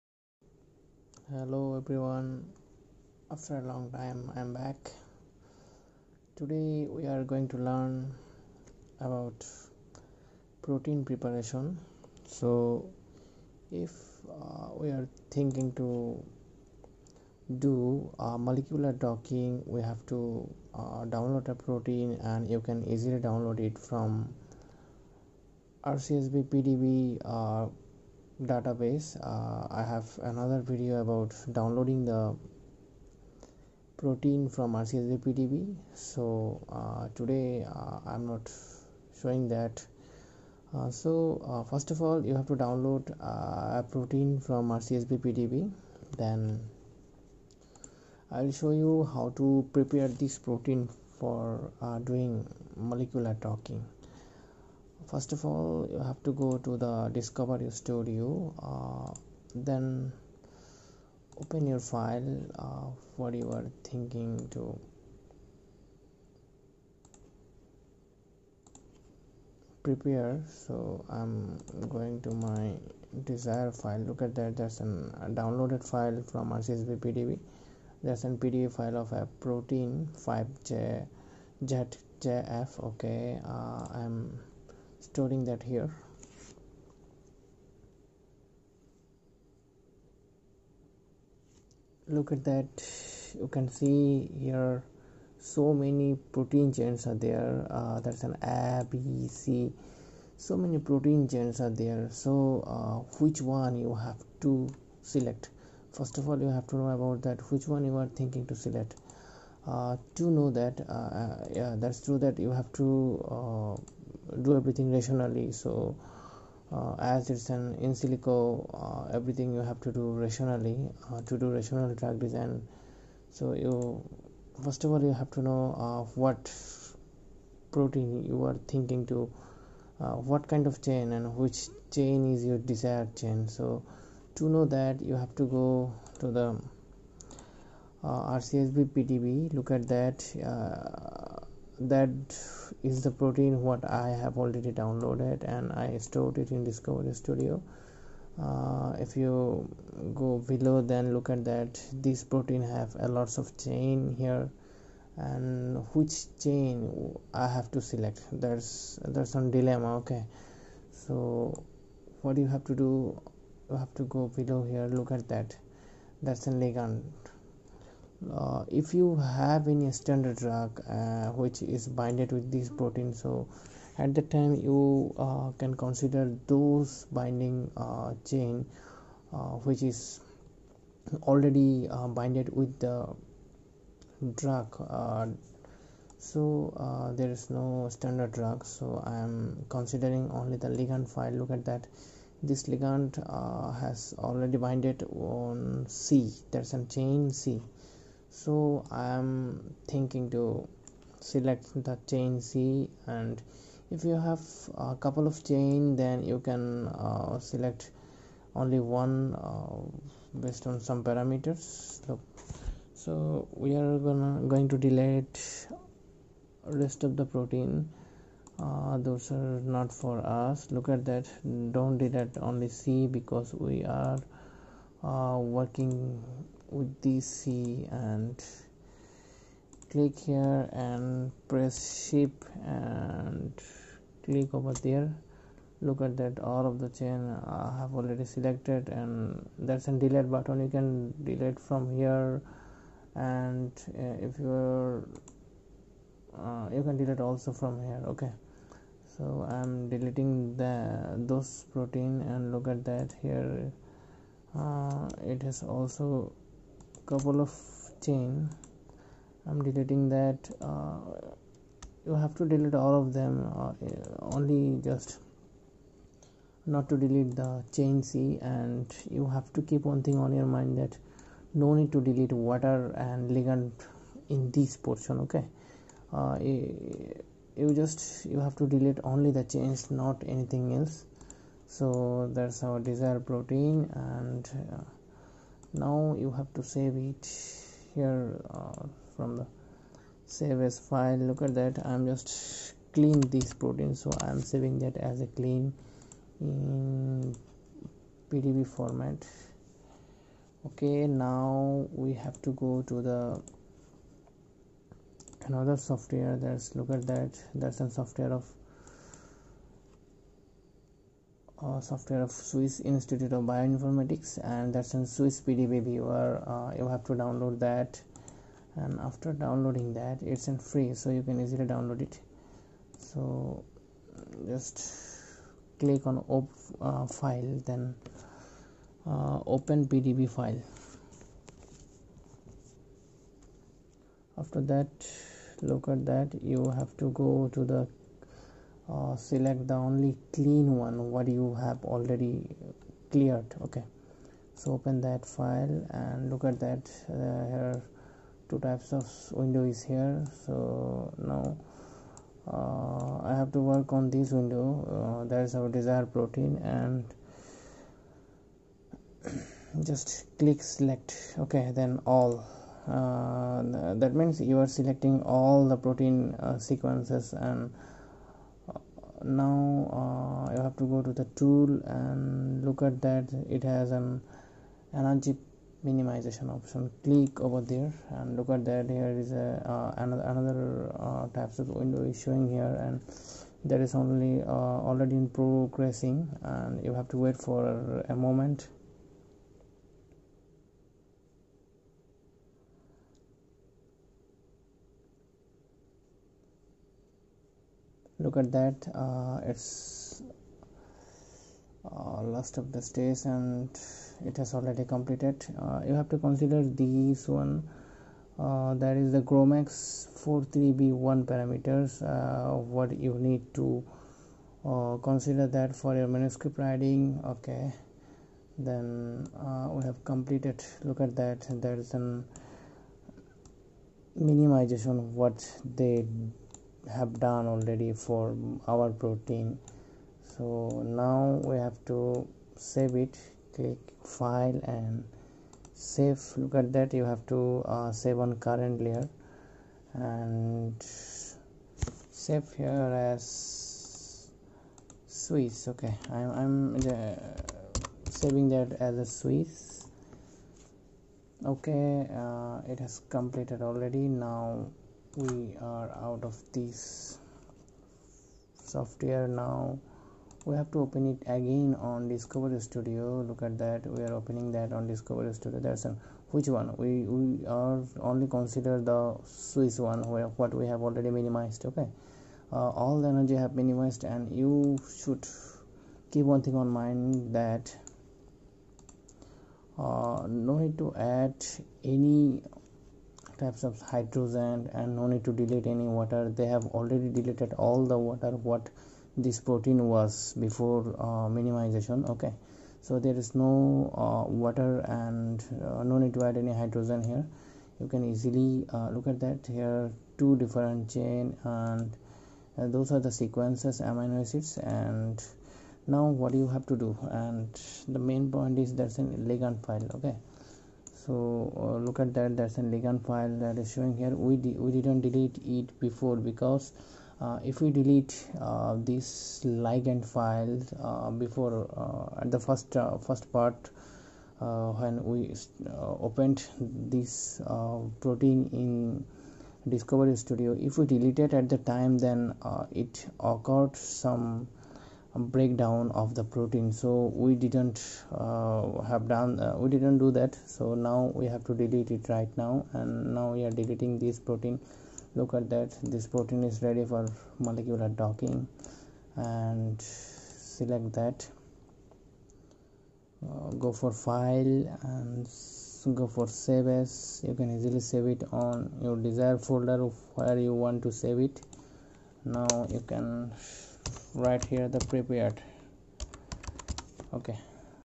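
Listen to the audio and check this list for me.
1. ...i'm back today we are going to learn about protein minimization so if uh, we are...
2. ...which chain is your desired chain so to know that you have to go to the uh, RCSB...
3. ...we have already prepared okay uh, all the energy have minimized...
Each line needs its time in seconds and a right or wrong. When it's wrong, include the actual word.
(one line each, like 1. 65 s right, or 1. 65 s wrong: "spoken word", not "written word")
1. 4 s wrong: "preparation", not "minimization"
2. 131 s right
3. 470 s wrong: "minimized", not "prepared".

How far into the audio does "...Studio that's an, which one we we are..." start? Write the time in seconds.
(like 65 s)
465 s.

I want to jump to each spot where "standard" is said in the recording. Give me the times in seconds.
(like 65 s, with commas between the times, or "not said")
169 s, 187 s.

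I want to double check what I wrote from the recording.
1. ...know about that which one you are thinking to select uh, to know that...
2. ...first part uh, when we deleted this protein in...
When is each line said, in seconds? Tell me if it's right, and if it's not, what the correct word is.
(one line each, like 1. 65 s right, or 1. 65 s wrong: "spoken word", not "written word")
1. 106 s right
2. 522 s wrong: "opened", not "deleted".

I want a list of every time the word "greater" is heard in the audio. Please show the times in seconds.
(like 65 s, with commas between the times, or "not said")
not said.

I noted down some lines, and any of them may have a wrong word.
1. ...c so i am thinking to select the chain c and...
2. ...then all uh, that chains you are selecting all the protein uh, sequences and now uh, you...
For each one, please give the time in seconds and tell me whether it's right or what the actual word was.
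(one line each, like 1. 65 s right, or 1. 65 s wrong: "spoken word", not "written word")
1. 197 s right
2. 361 s wrong: "means", not "chains".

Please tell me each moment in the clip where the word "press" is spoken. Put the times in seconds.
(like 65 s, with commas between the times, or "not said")
231 s.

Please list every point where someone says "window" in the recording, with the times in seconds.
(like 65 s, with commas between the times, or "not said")
349 s, 354 s, 381 s.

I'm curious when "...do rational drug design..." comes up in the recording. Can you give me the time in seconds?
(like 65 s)
121 s.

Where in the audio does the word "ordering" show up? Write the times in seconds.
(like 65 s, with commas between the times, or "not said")
not said.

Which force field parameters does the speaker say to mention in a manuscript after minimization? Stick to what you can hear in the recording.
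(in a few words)
GROMOS 43B1.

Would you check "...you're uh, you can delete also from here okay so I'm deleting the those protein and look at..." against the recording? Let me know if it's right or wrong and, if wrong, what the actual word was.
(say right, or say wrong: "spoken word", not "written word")
right.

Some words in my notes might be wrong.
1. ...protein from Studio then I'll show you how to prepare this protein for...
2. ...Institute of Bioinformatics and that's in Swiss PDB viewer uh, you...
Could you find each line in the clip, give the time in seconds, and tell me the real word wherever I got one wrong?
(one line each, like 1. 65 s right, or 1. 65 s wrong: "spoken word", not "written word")
1. 43 s wrong: "RCSBPDB", not "Studio"
2. 312 s right.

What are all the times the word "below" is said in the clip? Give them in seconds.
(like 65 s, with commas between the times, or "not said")
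150 s, 164 s.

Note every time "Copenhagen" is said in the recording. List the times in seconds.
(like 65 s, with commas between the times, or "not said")
not said.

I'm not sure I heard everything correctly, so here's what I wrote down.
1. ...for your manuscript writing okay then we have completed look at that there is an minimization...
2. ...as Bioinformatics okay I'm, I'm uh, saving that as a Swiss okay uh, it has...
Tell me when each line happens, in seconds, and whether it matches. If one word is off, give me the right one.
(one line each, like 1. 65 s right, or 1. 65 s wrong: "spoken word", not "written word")
1. 415 s right
2. 443 s wrong: "Swiss", not "Bioinformatics".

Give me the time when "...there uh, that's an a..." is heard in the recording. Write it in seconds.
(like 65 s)
97 s.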